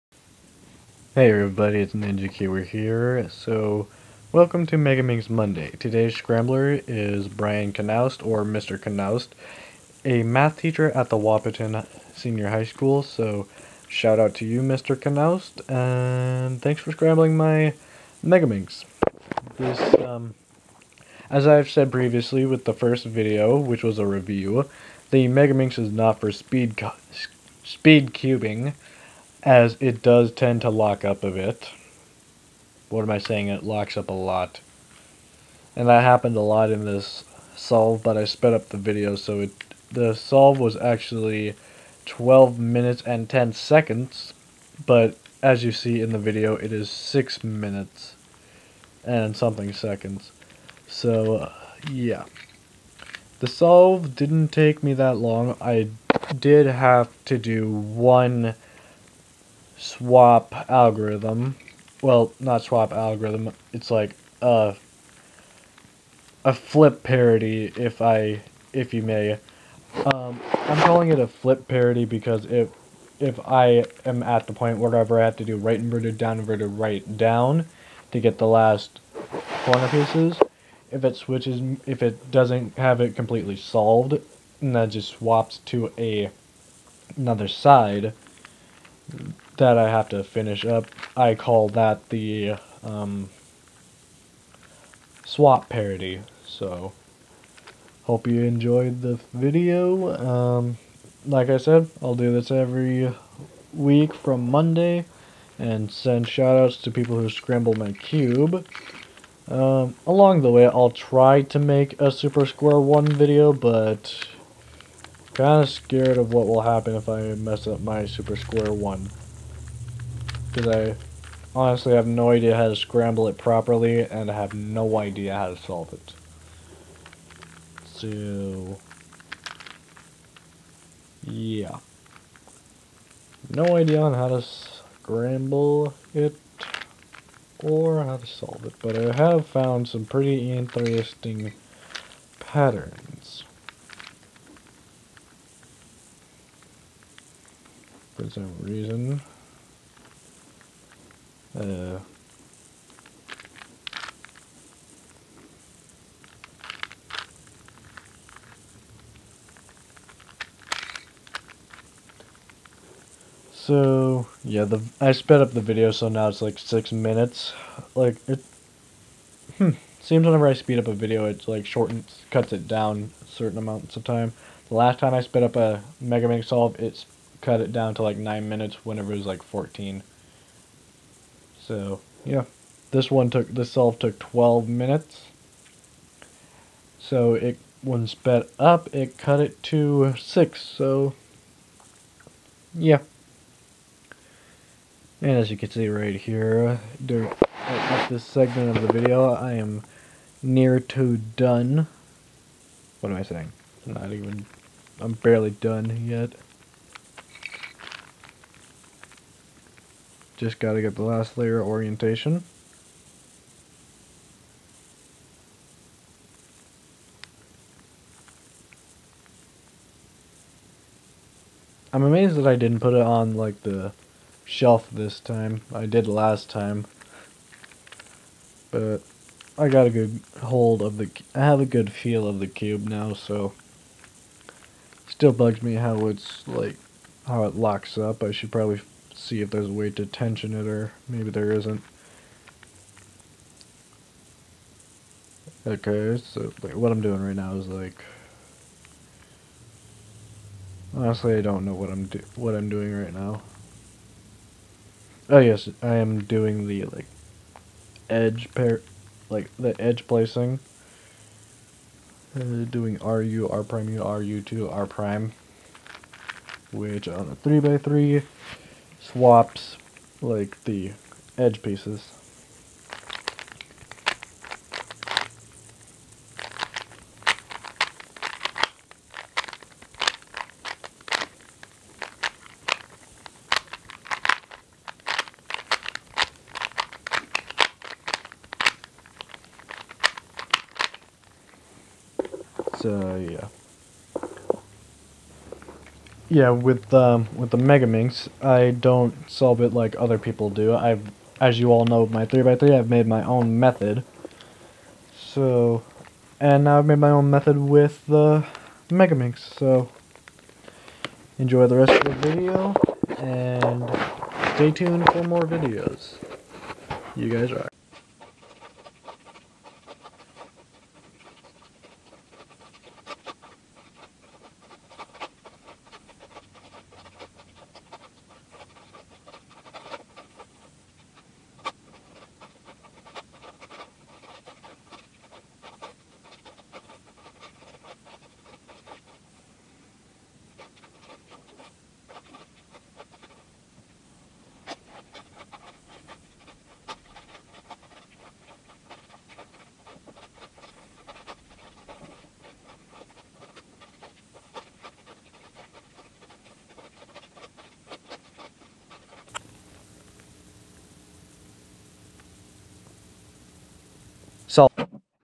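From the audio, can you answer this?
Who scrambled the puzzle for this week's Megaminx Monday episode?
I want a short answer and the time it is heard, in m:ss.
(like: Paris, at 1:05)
Brian Knaust, at 0:07.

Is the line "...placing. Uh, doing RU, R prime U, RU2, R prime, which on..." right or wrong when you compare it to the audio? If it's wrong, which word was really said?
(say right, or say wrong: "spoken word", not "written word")
right.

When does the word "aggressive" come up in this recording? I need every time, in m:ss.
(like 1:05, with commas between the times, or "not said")
not said.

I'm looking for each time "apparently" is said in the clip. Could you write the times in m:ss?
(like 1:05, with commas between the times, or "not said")
not said.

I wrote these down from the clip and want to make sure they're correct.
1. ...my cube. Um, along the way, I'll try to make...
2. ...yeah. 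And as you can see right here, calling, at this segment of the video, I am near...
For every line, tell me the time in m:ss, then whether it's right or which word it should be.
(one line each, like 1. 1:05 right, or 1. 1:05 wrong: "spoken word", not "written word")
1. 1:47 right
2. 3:12 wrong: "during", not "calling".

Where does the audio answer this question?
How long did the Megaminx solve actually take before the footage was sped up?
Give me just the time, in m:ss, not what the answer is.
0:42.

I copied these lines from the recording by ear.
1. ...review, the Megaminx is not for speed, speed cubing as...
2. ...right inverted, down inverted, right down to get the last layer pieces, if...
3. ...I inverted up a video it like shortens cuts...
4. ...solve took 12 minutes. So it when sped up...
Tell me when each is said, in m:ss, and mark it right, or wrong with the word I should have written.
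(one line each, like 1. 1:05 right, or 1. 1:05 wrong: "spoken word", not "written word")
1. 0:24 right
2. 1:15 wrong: "corner", not "layer"
3. 2:50 wrong: "speed", not "inverted"
4. 3:03 right.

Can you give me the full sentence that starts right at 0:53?
The solve didn't take me that long.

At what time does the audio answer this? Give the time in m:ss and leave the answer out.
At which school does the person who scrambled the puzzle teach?
0:11.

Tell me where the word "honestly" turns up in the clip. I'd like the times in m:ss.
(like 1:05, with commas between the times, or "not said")
2:01, 4:10.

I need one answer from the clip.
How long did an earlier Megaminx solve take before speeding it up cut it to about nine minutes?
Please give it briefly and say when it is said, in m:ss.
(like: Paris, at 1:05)
14 minutes, at 2:59.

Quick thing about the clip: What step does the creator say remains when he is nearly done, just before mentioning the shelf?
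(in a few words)
last layer orientation.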